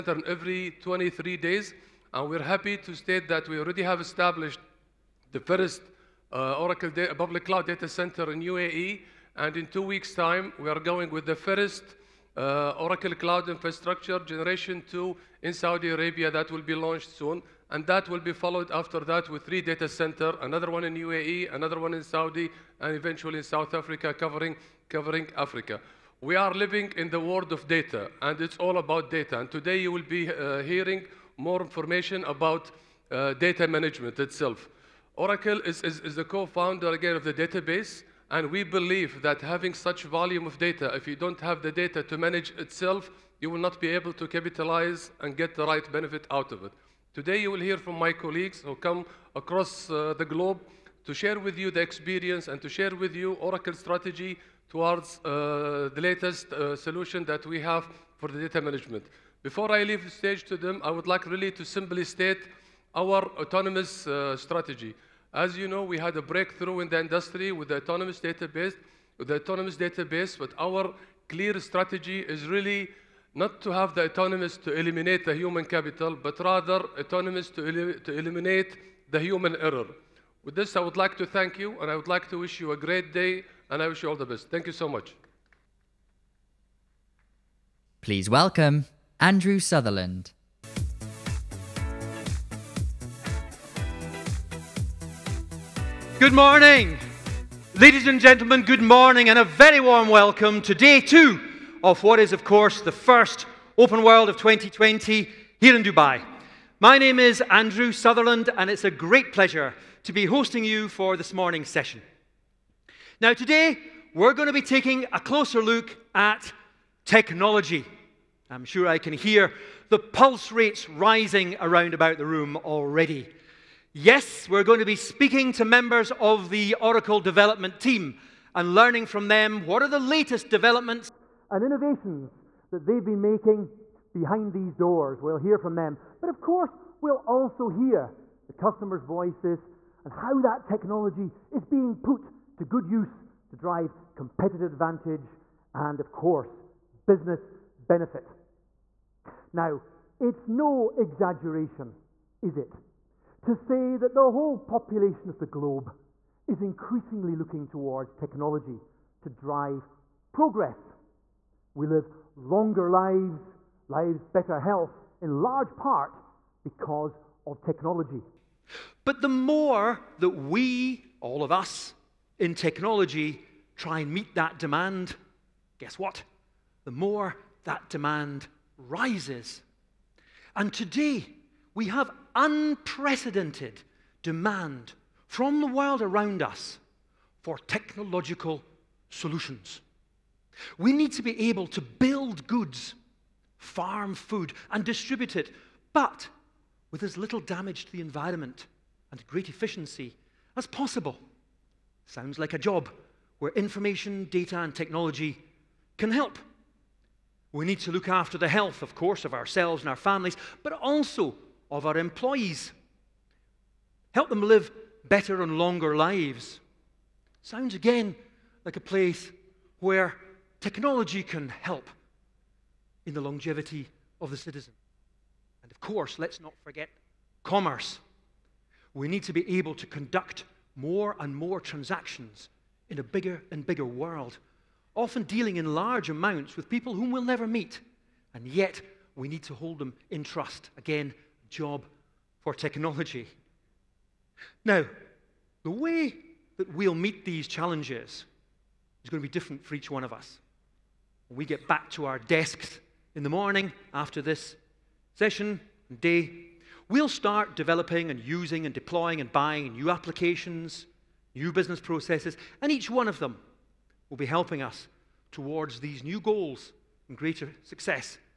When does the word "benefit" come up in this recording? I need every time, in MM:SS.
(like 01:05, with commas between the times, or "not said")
00:45, 02:27.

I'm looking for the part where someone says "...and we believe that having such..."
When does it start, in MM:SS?
00:38.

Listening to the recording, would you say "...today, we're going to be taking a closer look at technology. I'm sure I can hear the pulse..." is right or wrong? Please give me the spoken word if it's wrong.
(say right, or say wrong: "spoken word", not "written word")
right.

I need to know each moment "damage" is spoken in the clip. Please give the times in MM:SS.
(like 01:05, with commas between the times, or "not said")
03:17.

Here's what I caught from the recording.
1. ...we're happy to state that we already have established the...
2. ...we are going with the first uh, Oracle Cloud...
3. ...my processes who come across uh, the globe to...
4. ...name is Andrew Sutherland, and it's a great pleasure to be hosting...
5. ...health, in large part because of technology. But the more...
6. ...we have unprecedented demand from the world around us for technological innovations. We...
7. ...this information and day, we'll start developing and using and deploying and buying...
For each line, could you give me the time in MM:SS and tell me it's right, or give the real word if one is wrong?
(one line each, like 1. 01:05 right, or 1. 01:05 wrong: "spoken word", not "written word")
1. 00:02 right
2. 00:10 right
3. 00:47 wrong: "colleagues", not "processes"
4. 01:46 right
5. 02:44 right
6. 03:01 wrong: "solutions", not "innovations"
7. 04:14 wrong: "session", not "information".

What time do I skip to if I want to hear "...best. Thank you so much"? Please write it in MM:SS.
01:24.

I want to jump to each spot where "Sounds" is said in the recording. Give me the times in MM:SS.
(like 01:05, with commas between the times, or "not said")
03:22, 03:37.